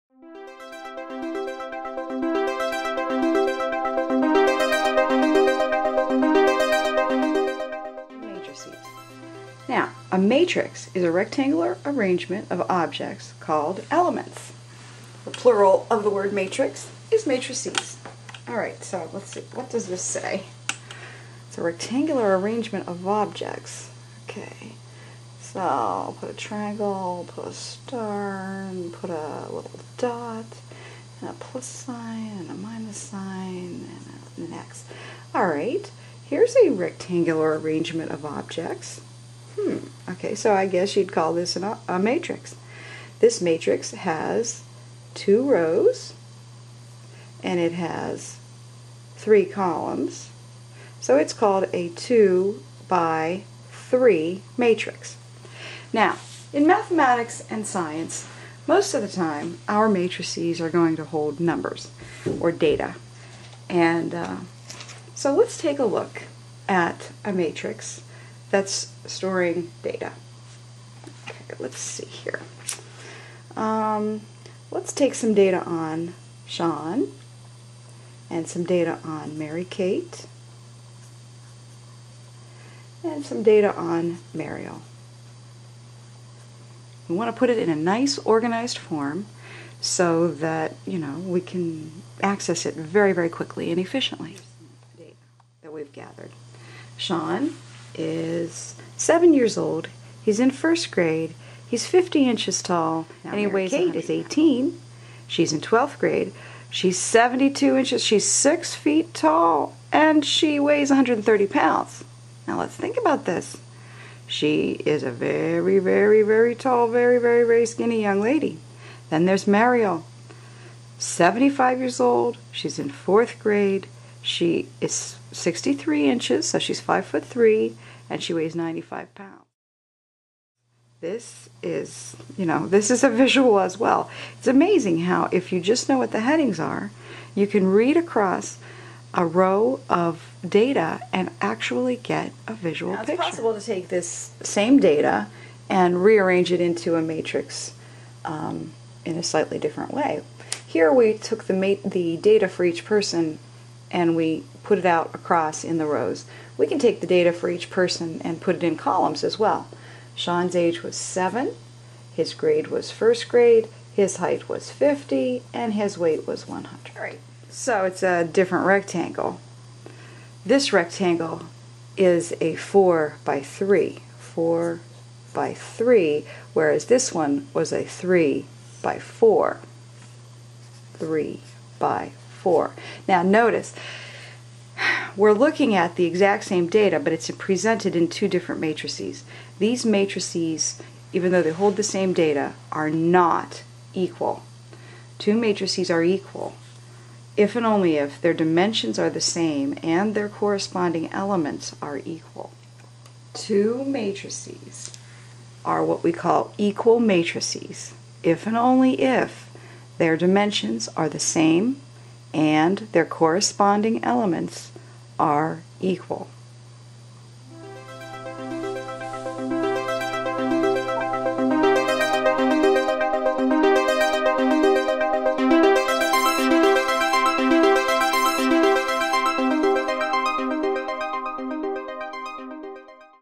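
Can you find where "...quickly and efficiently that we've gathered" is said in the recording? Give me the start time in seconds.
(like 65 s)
93 s.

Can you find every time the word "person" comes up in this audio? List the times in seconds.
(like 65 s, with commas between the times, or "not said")
152 s, 157 s.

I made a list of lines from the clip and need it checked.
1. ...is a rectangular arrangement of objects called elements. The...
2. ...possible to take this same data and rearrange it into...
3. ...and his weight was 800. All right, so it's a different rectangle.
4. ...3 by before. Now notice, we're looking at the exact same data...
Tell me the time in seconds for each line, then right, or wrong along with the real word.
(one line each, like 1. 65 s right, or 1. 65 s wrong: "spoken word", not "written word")
1. 10 s right
2. 143 s right
3. 165 s wrong: "100", not "800"
4. 180 s right.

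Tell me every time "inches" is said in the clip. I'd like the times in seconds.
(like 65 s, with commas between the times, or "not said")
102 s, 107 s, 126 s.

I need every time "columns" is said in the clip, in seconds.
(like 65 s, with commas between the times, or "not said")
49 s, 158 s.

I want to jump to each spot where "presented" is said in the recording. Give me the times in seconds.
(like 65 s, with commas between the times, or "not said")
187 s.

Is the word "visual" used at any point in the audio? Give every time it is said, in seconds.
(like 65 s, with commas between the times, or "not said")
133 s, 142 s.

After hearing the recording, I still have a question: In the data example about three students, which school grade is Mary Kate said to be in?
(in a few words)
12th grade.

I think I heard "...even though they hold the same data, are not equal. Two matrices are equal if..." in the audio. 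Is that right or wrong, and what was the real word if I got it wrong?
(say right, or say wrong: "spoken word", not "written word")
right.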